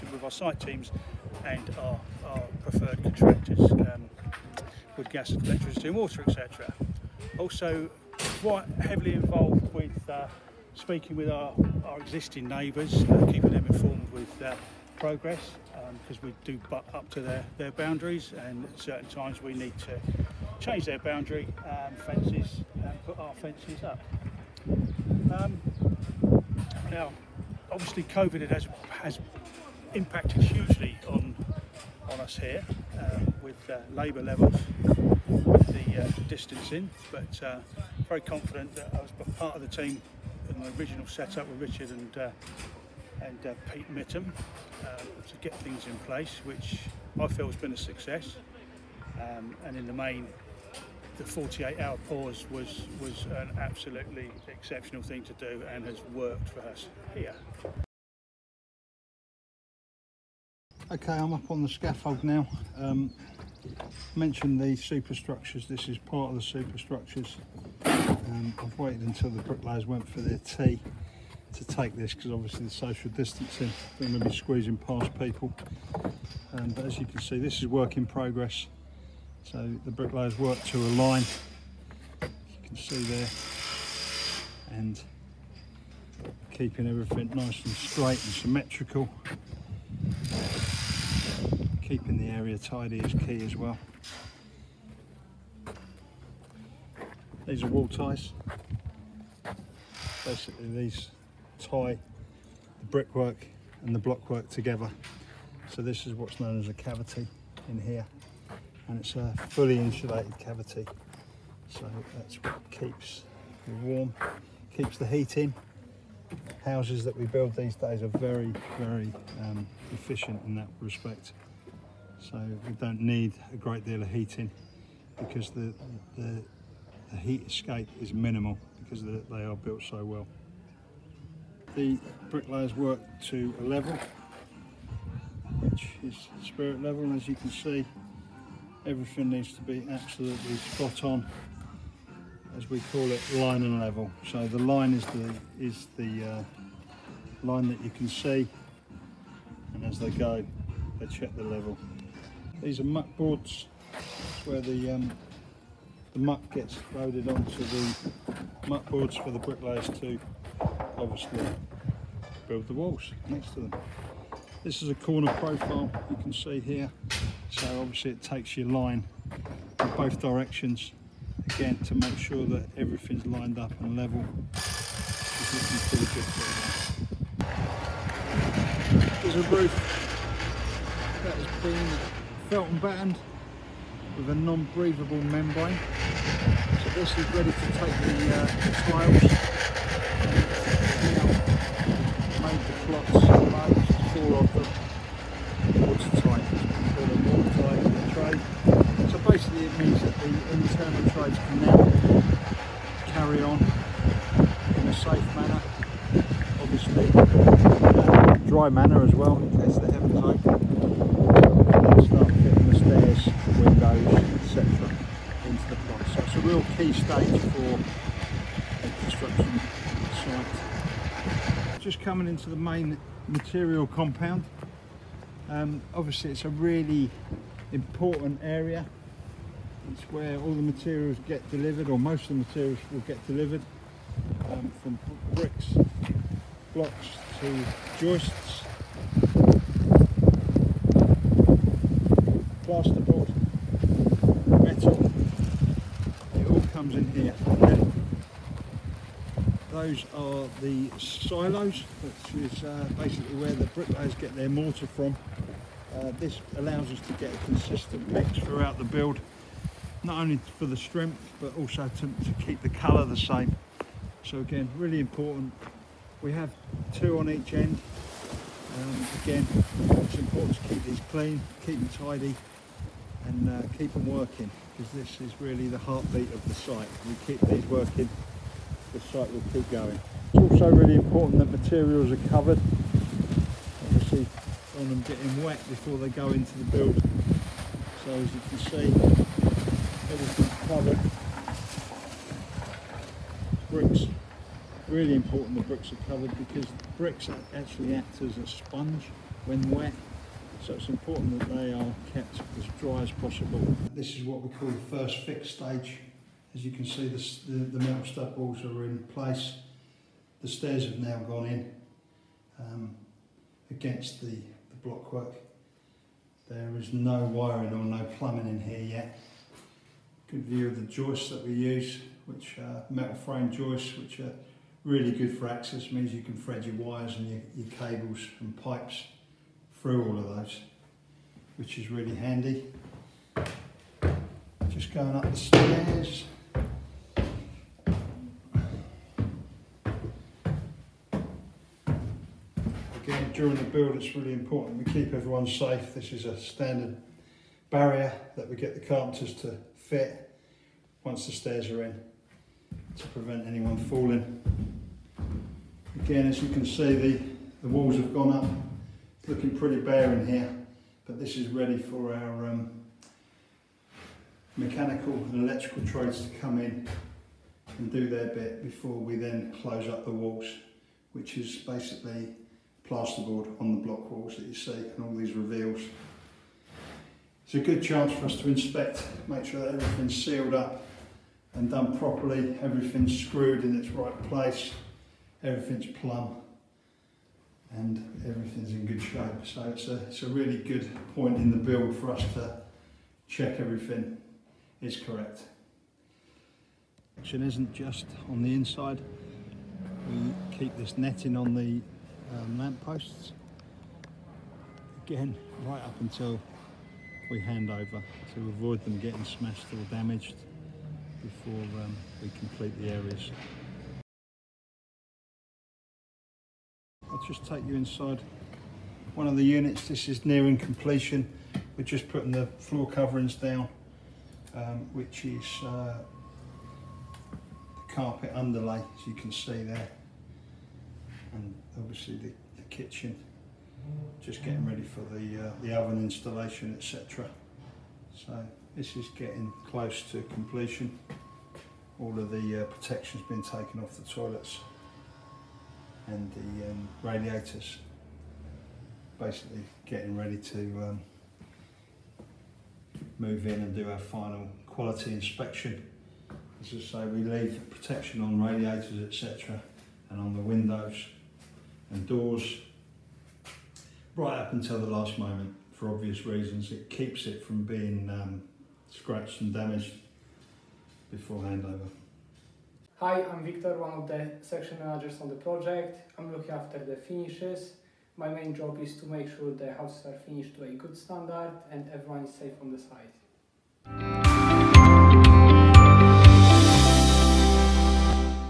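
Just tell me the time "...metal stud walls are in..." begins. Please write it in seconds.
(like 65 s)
307 s.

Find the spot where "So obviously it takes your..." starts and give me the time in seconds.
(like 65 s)
167 s.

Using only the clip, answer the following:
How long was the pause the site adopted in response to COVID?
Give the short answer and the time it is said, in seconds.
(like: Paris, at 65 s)
48-hour, at 51 s.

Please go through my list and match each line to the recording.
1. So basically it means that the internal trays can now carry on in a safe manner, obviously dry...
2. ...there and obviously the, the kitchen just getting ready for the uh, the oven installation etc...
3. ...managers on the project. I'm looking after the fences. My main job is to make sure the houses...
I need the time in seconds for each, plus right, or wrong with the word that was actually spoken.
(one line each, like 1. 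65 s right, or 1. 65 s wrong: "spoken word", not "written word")
1. 199 s right
2. 429 s right
3. 474 s wrong: "finishes", not "fences".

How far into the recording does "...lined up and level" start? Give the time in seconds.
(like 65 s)
173 s.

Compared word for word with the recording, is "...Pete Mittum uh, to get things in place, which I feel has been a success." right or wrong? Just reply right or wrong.
right.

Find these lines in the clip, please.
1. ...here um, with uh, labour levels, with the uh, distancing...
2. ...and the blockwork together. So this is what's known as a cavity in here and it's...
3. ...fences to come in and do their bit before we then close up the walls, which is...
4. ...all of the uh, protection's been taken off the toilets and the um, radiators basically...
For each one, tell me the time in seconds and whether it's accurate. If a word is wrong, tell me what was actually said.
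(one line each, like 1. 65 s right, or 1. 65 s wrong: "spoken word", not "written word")
1. 32 s right
2. 103 s right
3. 365 s wrong: "trades", not "fences"
4. 441 s right.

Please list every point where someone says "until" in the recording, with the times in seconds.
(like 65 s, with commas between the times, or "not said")
69 s, 405 s, 464 s.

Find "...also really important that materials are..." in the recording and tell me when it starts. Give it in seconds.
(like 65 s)
280 s.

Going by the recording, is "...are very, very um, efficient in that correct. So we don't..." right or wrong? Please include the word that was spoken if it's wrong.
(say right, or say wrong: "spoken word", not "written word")
wrong: "respect", not "correct".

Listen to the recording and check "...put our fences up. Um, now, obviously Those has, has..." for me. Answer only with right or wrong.
wrong.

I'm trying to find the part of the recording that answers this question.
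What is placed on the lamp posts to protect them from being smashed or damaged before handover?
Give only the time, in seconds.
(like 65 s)
400 s.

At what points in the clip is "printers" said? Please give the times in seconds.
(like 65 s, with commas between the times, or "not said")
not said.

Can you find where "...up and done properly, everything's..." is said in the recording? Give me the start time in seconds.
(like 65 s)
380 s.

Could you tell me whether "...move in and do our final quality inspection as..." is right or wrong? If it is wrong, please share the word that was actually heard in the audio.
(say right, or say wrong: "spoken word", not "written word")
right.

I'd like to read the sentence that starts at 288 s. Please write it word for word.
So as you can see, everything's covered.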